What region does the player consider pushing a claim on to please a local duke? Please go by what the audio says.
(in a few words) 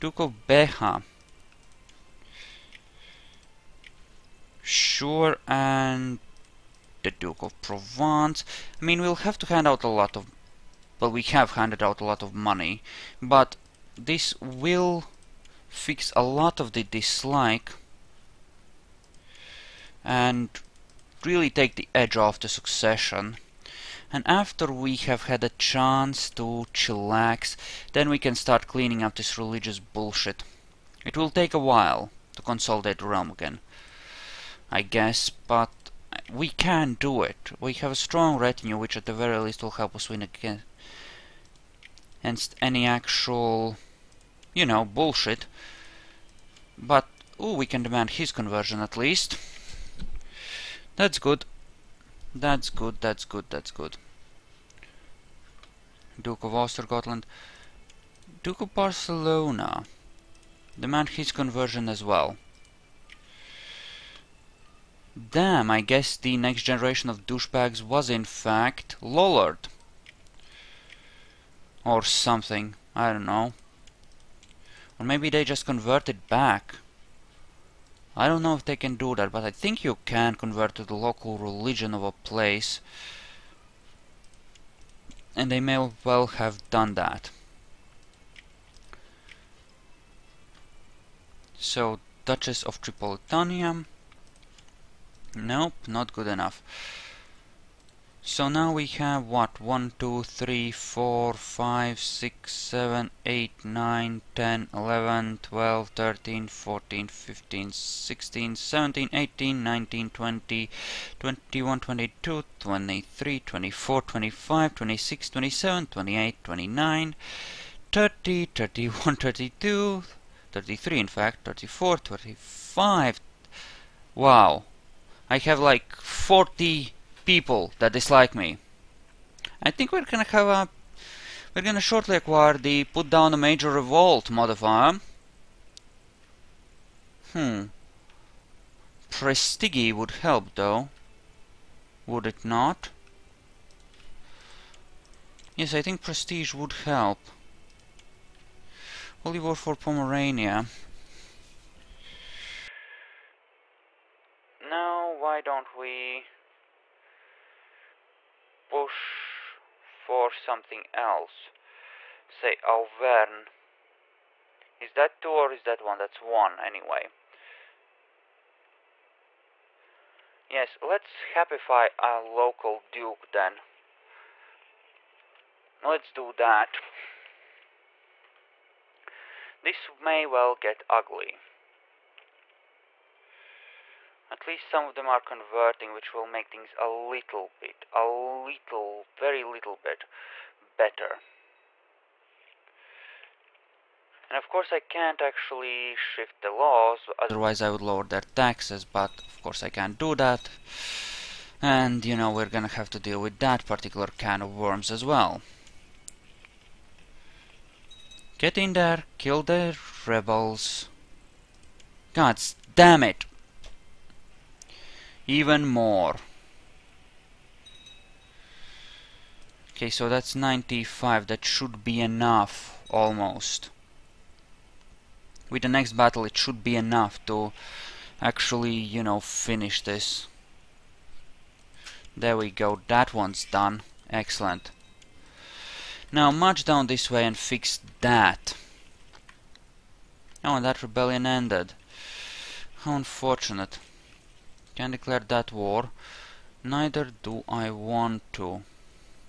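Auvergne.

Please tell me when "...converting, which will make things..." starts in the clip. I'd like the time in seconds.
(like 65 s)
185 s.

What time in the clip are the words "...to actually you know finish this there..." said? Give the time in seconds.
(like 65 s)
227 s.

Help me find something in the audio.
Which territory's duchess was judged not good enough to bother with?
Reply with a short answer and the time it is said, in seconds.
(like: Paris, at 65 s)
Tripolitania, at 92 s.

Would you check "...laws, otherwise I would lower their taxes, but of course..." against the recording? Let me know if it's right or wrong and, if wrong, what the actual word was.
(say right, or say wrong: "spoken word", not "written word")
right.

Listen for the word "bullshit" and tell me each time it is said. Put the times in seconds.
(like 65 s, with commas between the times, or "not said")
29 s, 44 s.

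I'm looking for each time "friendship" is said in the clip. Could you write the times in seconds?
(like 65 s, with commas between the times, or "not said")
not said.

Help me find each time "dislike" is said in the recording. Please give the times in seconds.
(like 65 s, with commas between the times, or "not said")
16 s, 127 s.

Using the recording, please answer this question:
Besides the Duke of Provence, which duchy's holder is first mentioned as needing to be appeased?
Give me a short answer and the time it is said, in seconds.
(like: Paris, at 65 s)
Beja, at 0 s.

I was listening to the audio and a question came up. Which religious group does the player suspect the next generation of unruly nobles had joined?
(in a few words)
Lollard.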